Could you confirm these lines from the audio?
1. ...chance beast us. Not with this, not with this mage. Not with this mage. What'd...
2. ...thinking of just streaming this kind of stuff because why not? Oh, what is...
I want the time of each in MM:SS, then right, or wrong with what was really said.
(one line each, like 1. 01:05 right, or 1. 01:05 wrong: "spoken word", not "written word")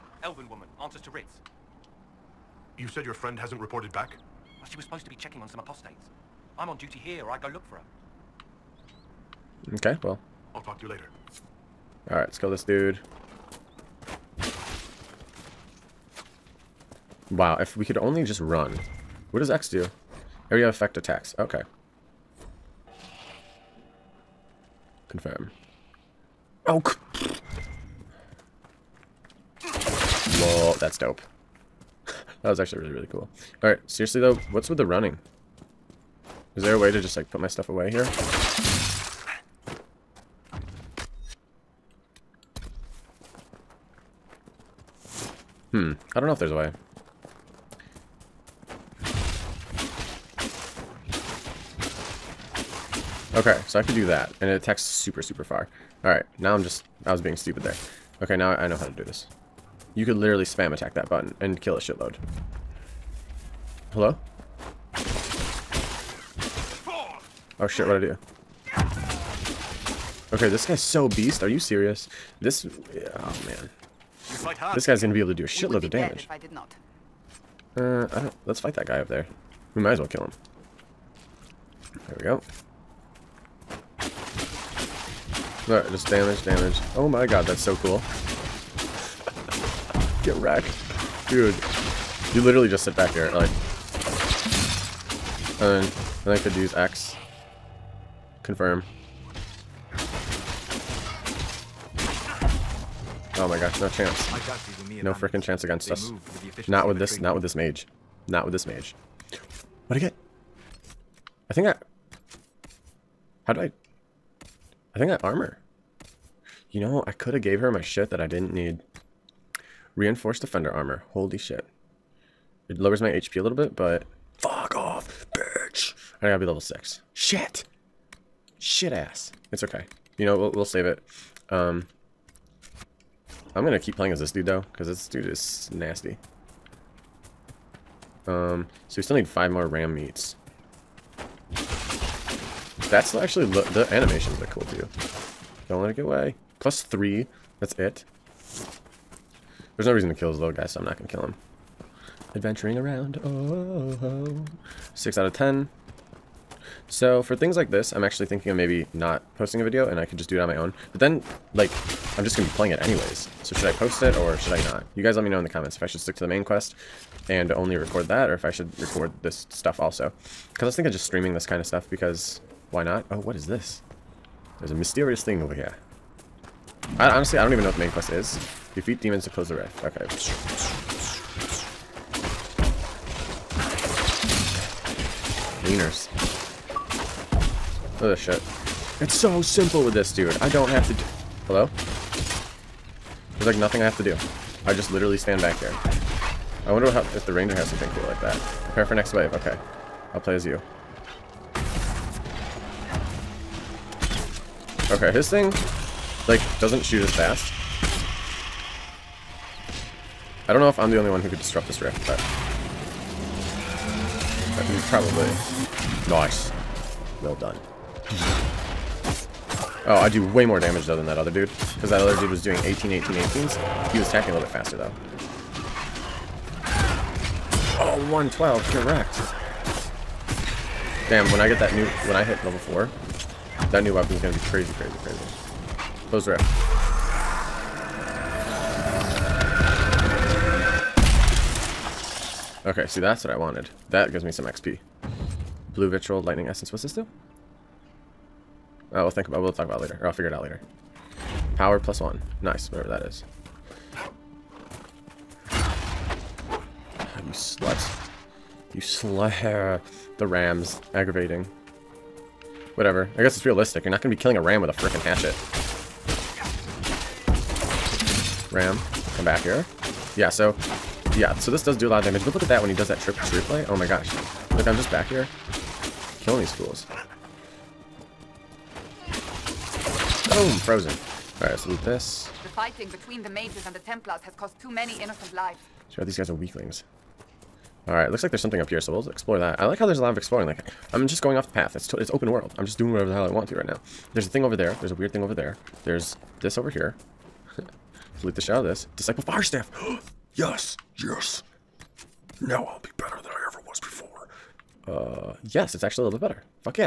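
1. 01:45 wrong: "against", not "beast"
2. 02:50 right.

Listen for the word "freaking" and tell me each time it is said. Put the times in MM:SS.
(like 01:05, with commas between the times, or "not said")
01:45, 04:24.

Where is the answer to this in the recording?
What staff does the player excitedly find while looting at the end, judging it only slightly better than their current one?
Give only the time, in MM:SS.
04:58.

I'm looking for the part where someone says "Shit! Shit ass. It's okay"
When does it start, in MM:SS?
02:07.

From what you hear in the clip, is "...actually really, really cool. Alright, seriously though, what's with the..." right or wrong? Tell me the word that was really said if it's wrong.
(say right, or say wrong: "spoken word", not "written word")
right.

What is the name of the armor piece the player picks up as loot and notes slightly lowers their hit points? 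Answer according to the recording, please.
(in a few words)
Reinforced defender armor.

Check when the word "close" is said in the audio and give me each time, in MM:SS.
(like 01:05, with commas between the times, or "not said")
02:59, 03:56.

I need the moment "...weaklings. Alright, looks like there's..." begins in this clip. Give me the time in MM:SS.
04:46.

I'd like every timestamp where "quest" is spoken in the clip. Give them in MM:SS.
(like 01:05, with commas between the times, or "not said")
02:46, 02:57.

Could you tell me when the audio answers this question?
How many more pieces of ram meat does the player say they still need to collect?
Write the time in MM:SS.
02:19.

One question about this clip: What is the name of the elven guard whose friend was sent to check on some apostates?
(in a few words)
Ritts.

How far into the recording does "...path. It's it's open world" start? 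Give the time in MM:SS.
04:51.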